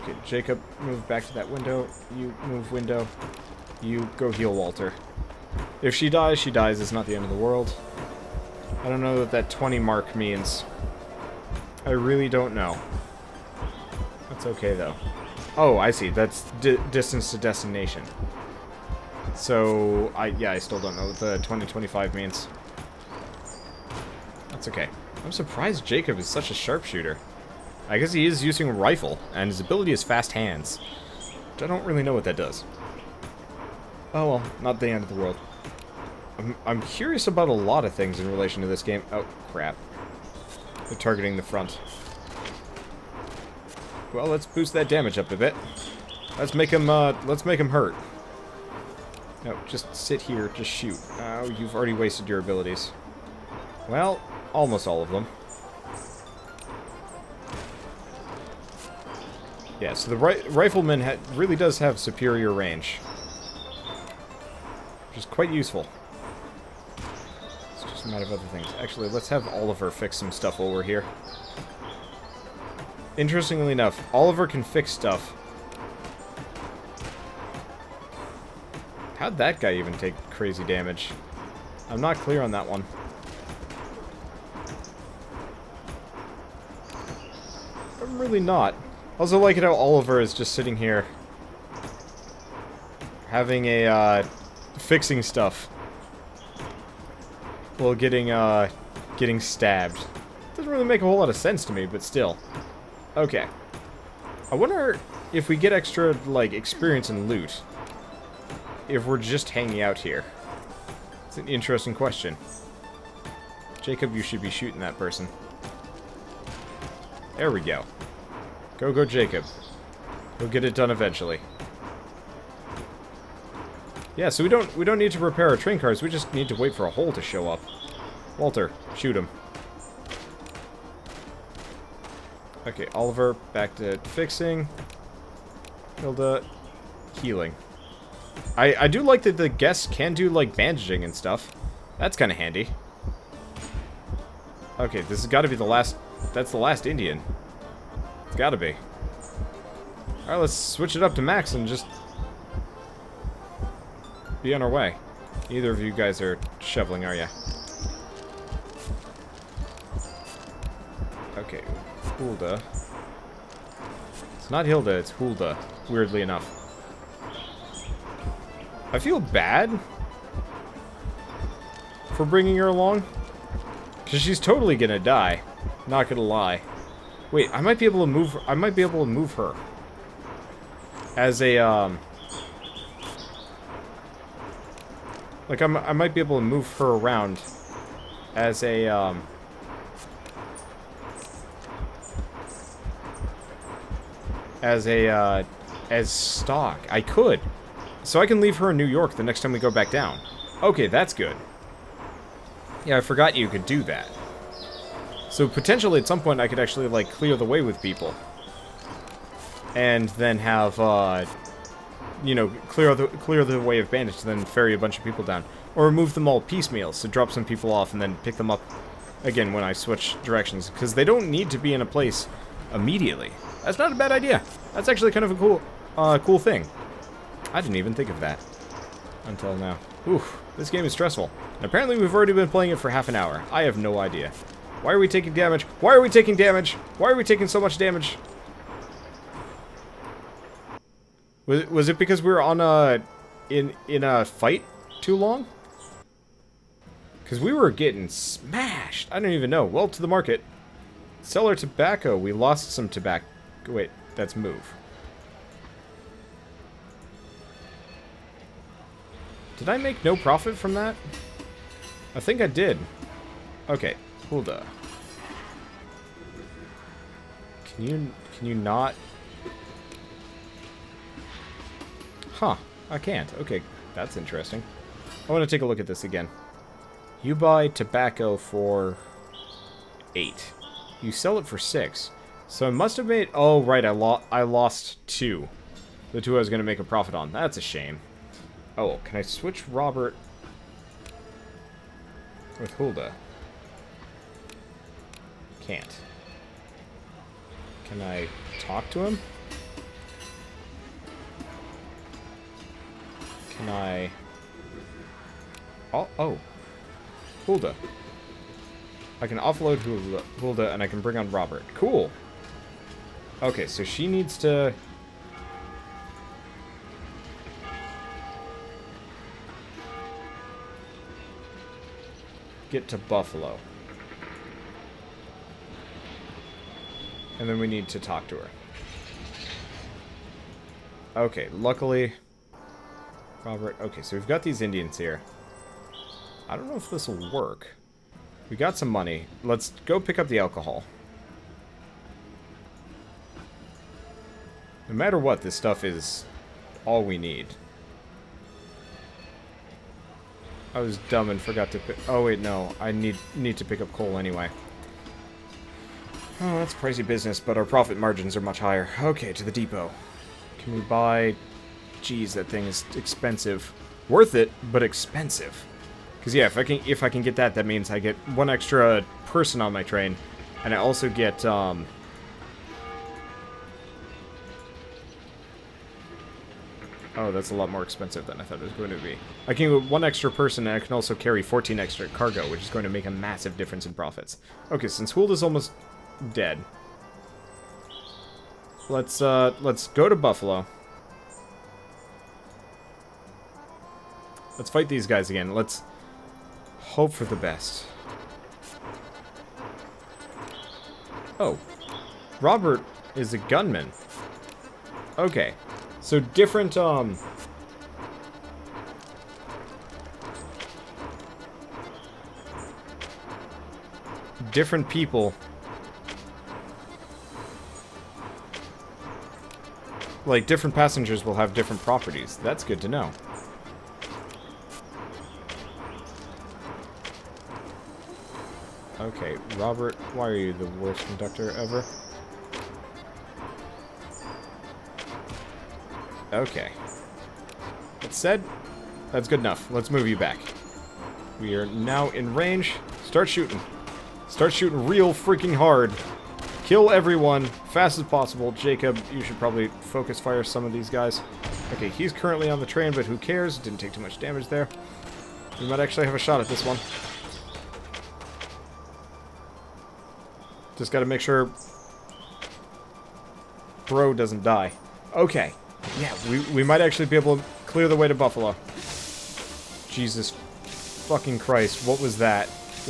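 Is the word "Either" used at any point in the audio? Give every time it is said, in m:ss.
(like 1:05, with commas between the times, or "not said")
2:35.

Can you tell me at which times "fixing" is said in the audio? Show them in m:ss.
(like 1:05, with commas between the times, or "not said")
1:34, 2:14.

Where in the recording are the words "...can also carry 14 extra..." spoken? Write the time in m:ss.
6:20.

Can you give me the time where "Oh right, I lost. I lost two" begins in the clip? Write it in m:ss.
4:43.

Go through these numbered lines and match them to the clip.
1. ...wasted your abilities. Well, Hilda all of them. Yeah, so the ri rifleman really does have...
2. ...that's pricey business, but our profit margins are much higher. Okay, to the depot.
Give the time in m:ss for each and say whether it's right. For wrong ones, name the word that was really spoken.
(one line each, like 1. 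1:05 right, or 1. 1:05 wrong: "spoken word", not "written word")
1. 0:51 wrong: "Almost", not "Hilda"
2. 5:56 right.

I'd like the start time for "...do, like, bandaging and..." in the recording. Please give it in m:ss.
2:20.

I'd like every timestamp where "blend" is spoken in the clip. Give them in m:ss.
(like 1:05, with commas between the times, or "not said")
not said.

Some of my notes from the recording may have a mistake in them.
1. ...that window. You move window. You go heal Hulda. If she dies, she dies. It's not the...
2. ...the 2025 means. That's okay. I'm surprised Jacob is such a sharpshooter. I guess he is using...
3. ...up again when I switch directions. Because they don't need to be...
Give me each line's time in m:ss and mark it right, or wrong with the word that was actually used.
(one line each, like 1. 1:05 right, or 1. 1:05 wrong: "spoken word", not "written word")
1. 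0:01 wrong: "Walter", not "Hulda"
2. 0:21 right
3. 3:38 right.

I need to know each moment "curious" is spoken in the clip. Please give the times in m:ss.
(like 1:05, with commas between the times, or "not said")
0:36.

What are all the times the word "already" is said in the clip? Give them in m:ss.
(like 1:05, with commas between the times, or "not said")
0:51, 3:52.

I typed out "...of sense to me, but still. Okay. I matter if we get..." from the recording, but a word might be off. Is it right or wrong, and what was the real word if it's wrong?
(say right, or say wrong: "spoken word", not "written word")
wrong: "wonder", not "matter".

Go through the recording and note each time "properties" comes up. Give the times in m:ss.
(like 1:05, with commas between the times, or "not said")
7:01.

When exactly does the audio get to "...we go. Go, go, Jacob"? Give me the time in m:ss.
1:57.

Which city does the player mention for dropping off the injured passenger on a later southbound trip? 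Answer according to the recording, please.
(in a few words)
New York.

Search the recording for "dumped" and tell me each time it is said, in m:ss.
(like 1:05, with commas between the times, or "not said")
not said.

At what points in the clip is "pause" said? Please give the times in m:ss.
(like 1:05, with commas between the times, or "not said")
not said.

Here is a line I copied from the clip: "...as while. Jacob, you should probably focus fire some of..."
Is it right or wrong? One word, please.
wrong.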